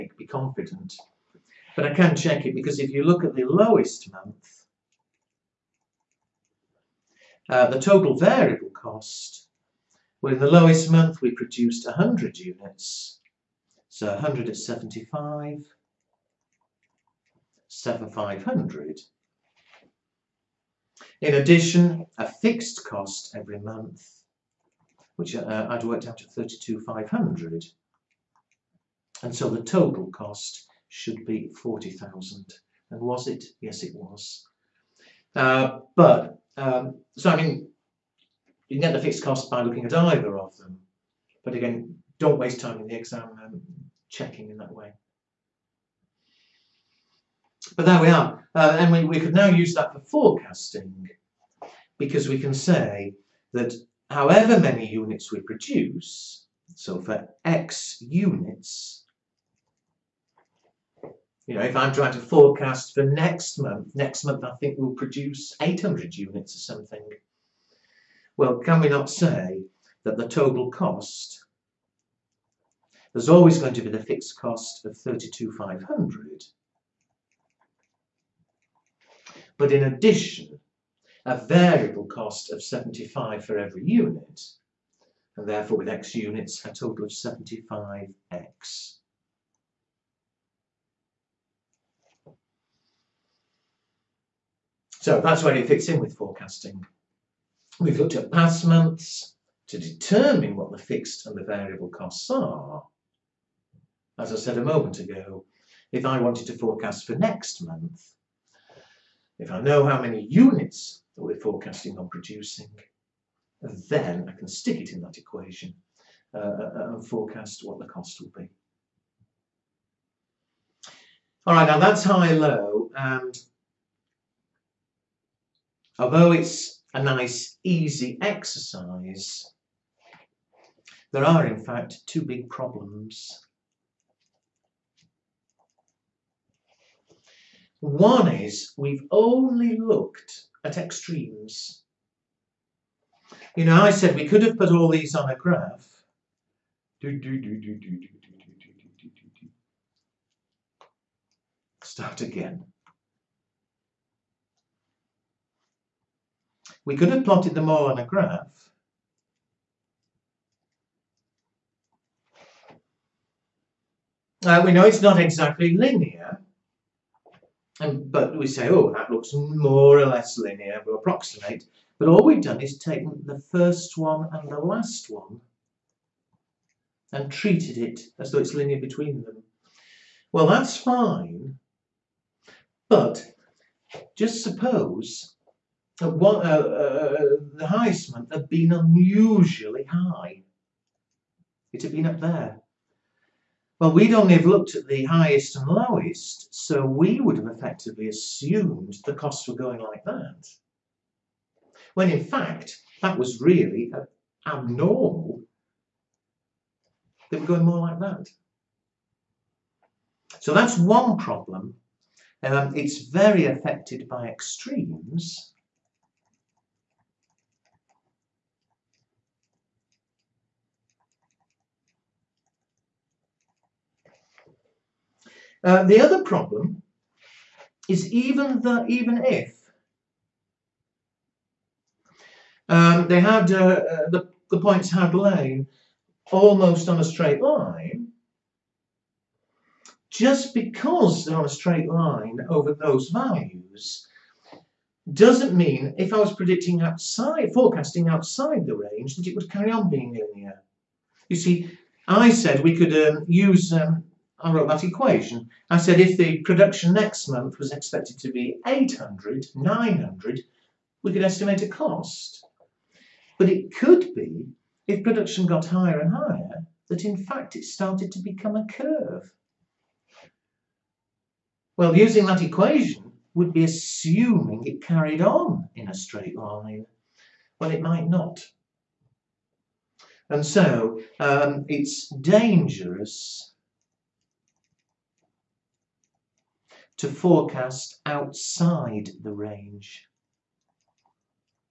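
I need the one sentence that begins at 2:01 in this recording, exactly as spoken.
All right, now that's high-low, and although it's a nice easy exercise, there are in fact two big problems.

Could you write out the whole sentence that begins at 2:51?
But all we've done is taken the first one and the last one and treated it as though it's linear between them.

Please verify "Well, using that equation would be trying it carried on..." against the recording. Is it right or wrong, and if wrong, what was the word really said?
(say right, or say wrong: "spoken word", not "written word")
wrong: "assuming", not "trying".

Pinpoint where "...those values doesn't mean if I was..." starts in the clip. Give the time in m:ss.
4:02.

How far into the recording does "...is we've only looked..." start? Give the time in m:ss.
2:18.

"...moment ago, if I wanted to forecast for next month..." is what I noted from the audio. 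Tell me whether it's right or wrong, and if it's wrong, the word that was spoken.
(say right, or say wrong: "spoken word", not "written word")
right.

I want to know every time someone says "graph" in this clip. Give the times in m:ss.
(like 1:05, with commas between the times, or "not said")
2:25, 2:38.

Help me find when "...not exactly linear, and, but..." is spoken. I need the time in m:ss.
2:45.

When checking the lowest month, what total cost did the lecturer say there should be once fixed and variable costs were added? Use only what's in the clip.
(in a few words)
40,000.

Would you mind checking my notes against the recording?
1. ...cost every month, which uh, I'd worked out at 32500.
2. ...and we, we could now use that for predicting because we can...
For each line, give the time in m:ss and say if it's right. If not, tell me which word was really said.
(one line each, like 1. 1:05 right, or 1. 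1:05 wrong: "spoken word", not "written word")
1. 0:22 right
2. 0:48 wrong: "forecasting", not "predicting".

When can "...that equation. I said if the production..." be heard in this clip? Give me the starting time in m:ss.
4:14.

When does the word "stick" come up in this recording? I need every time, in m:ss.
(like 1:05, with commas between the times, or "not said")
1:54.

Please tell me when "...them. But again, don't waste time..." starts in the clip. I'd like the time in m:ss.
0:40.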